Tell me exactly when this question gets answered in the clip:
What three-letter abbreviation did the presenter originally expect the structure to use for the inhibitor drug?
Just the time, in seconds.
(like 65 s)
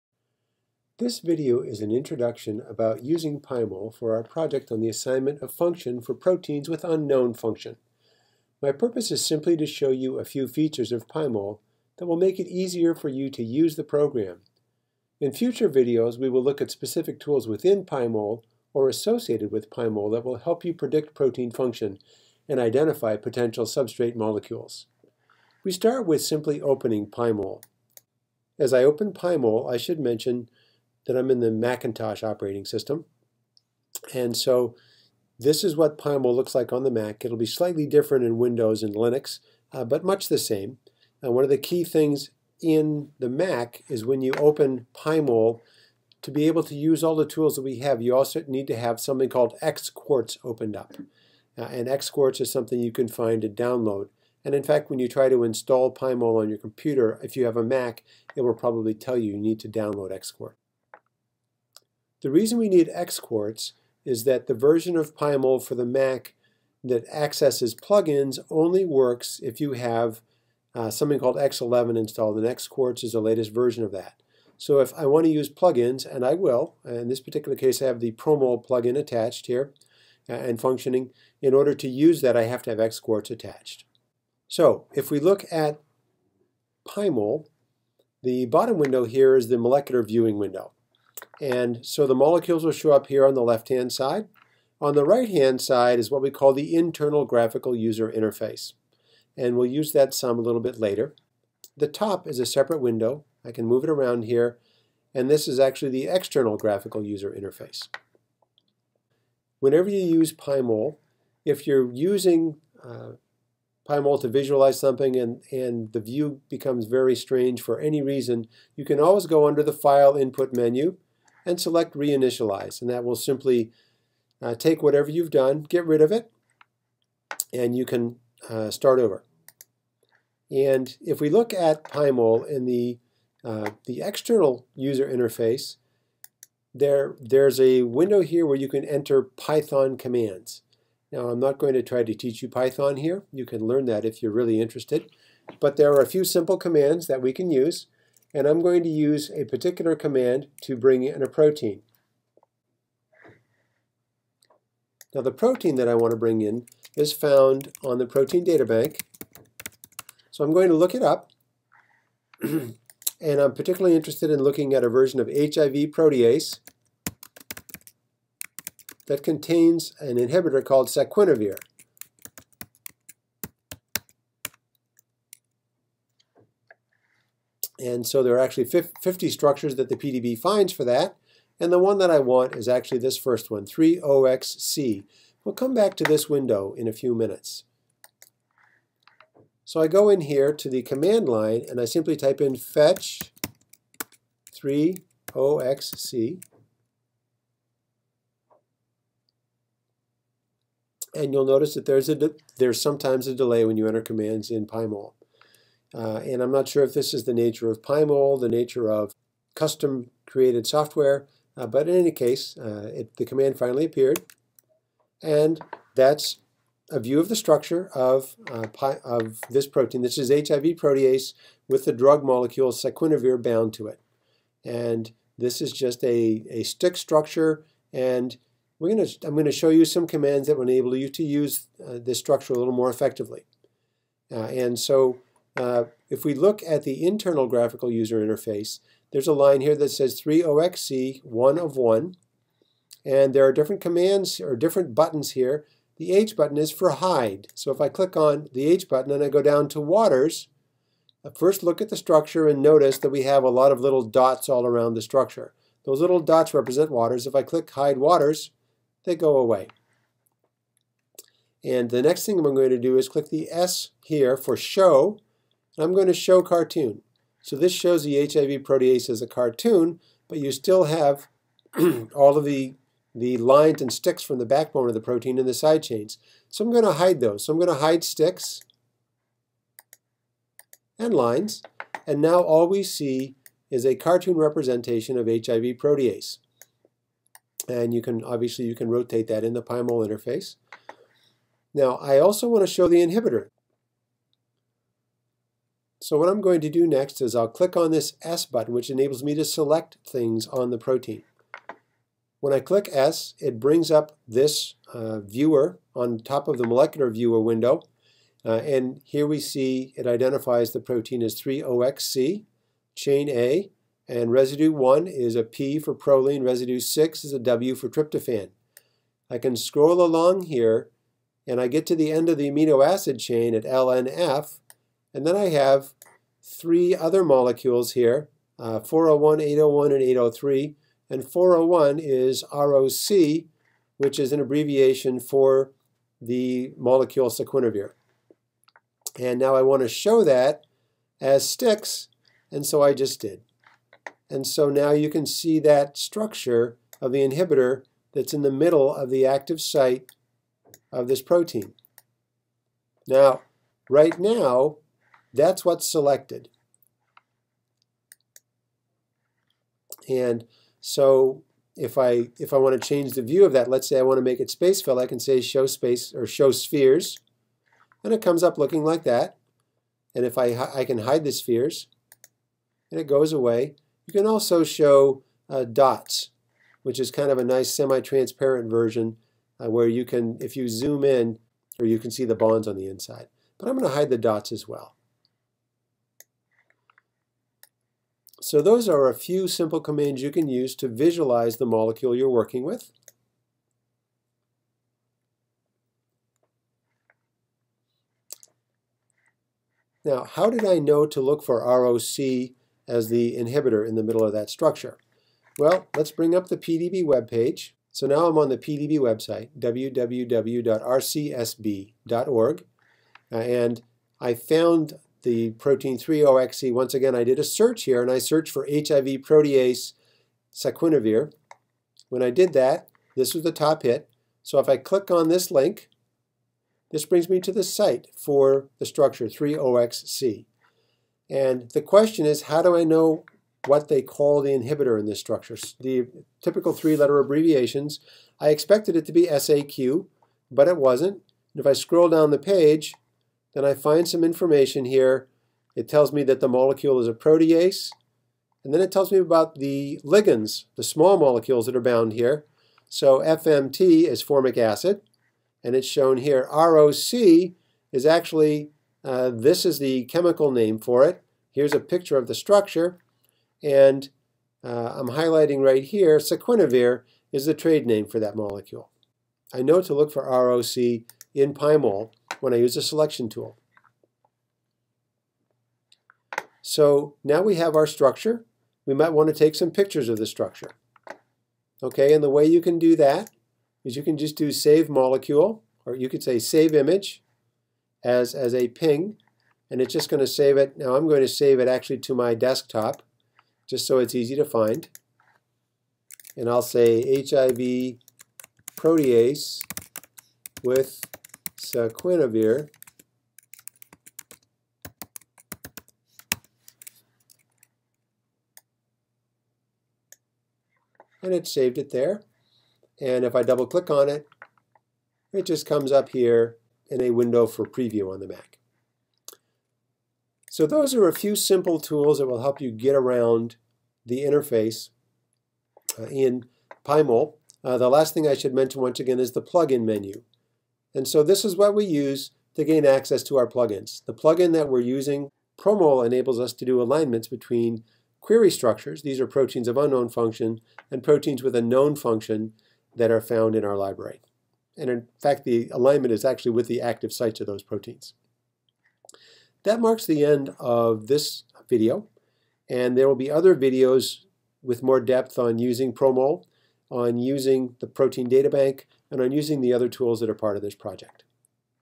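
439 s.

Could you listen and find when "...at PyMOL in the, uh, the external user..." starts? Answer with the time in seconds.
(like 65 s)
131 s.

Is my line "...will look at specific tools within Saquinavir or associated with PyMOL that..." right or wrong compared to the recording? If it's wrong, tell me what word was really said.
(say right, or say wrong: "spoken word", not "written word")
wrong: "PyMOL", not "Saquinavir".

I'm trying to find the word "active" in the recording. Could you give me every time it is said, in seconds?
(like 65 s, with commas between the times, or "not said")
349 s, 546 s.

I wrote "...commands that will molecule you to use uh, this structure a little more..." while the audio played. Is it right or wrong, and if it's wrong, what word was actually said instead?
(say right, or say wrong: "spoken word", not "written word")
wrong: "enable", not "molecule".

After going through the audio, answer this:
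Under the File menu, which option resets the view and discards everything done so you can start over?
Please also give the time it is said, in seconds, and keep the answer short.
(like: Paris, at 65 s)
reinitialize, at 121 s.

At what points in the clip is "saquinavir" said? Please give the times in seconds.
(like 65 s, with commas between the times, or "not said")
222 s, 337 s, 420 s, 466 s, 501 s.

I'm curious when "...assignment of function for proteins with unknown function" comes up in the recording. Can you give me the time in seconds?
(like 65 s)
4 s.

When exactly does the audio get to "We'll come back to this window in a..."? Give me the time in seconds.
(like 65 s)
185 s.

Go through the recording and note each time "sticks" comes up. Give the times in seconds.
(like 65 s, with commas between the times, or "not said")
226 s, 273 s, 278 s, 341 s.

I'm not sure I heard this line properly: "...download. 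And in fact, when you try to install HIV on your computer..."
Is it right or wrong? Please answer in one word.
wrong.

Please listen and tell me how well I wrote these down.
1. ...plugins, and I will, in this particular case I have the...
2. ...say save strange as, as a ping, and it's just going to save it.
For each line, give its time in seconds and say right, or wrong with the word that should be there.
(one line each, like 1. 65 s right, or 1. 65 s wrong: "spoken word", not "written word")
1. 75 s right
2. 486 s wrong: "image", not "strange".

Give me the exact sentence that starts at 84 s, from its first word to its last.
So if we look at PyMOL, the bottom window here is the molecular viewing window.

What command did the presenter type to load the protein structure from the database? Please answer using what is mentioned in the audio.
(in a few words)
fetch 3OXC.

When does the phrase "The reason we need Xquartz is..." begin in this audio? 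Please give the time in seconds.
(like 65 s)
62 s.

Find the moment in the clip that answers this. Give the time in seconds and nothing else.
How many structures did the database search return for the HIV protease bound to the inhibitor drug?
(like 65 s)
178 s.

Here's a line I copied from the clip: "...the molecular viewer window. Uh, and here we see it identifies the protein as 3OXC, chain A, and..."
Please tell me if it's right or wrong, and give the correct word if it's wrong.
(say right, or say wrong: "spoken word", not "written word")
right.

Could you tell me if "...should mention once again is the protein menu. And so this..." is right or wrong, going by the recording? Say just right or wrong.
wrong.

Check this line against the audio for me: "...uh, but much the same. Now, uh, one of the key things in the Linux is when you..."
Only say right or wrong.
wrong.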